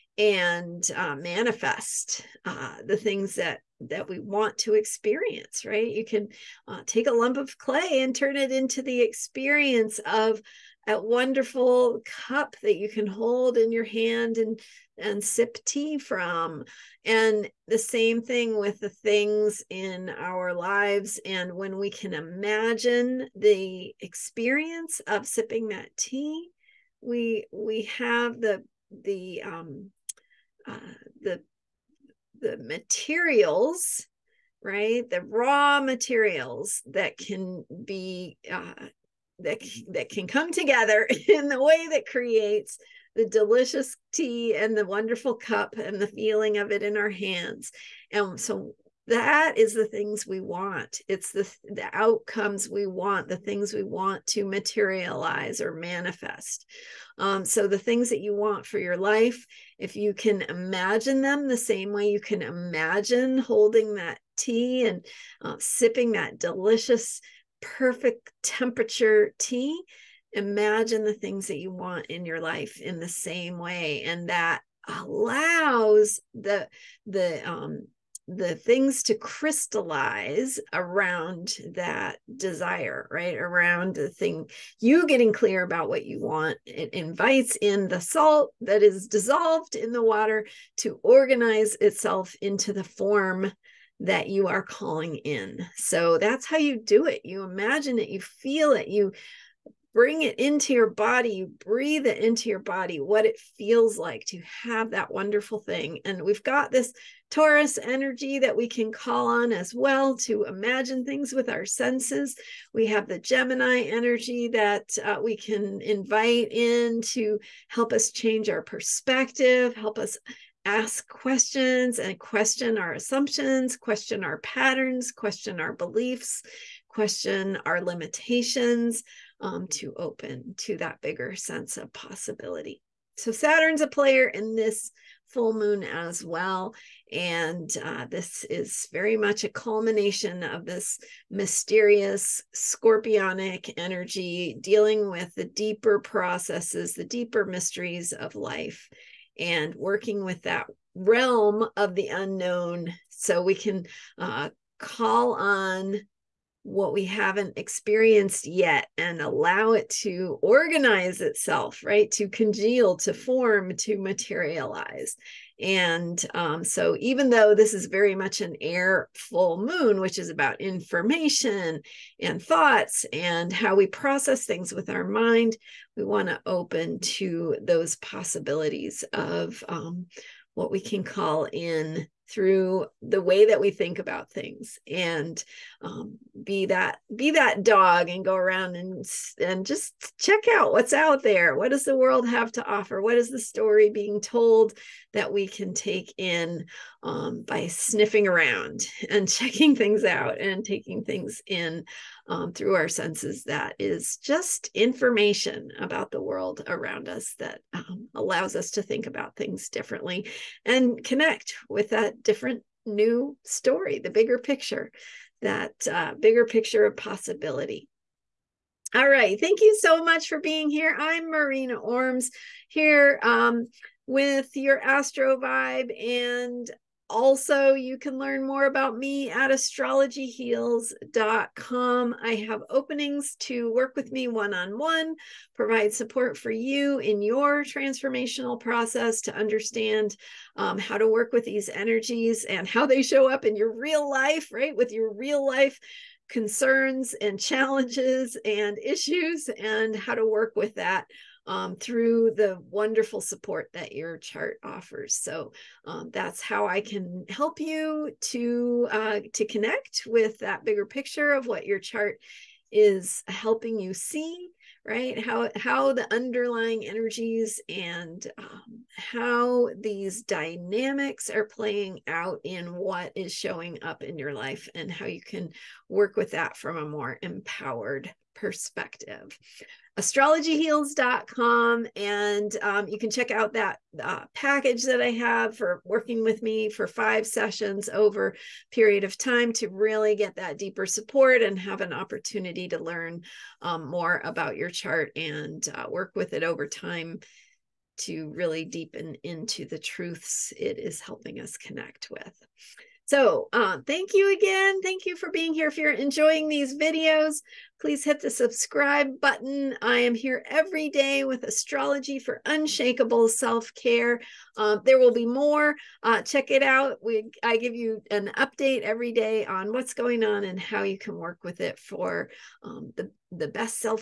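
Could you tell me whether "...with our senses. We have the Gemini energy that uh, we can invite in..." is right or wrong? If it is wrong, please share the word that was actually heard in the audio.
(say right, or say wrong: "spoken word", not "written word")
right.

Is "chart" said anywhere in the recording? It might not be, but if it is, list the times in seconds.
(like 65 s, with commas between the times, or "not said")
254 s, 261 s, 294 s.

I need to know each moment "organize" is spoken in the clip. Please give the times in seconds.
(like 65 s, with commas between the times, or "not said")
91 s, 160 s.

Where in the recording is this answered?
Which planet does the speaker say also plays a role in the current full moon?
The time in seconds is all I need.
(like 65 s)
133 s.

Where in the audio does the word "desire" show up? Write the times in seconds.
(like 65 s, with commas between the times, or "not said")
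82 s.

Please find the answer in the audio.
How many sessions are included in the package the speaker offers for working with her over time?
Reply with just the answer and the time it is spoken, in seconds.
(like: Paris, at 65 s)
5, at 286 s.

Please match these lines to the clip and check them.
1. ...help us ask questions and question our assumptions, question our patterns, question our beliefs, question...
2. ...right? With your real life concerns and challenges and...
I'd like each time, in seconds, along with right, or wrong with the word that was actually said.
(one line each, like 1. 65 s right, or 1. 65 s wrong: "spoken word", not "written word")
1. 119 s right
2. 244 s right.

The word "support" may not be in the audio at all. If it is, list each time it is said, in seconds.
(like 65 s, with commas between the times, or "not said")
235 s, 253 s, 290 s.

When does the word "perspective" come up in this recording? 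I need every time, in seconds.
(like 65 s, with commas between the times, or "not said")
118 s, 278 s.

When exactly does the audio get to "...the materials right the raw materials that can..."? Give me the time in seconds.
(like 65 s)
32 s.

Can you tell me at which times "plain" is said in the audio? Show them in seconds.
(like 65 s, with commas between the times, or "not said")
not said.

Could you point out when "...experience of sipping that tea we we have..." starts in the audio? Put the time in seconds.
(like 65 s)
23 s.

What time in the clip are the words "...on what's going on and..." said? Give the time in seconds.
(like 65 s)
319 s.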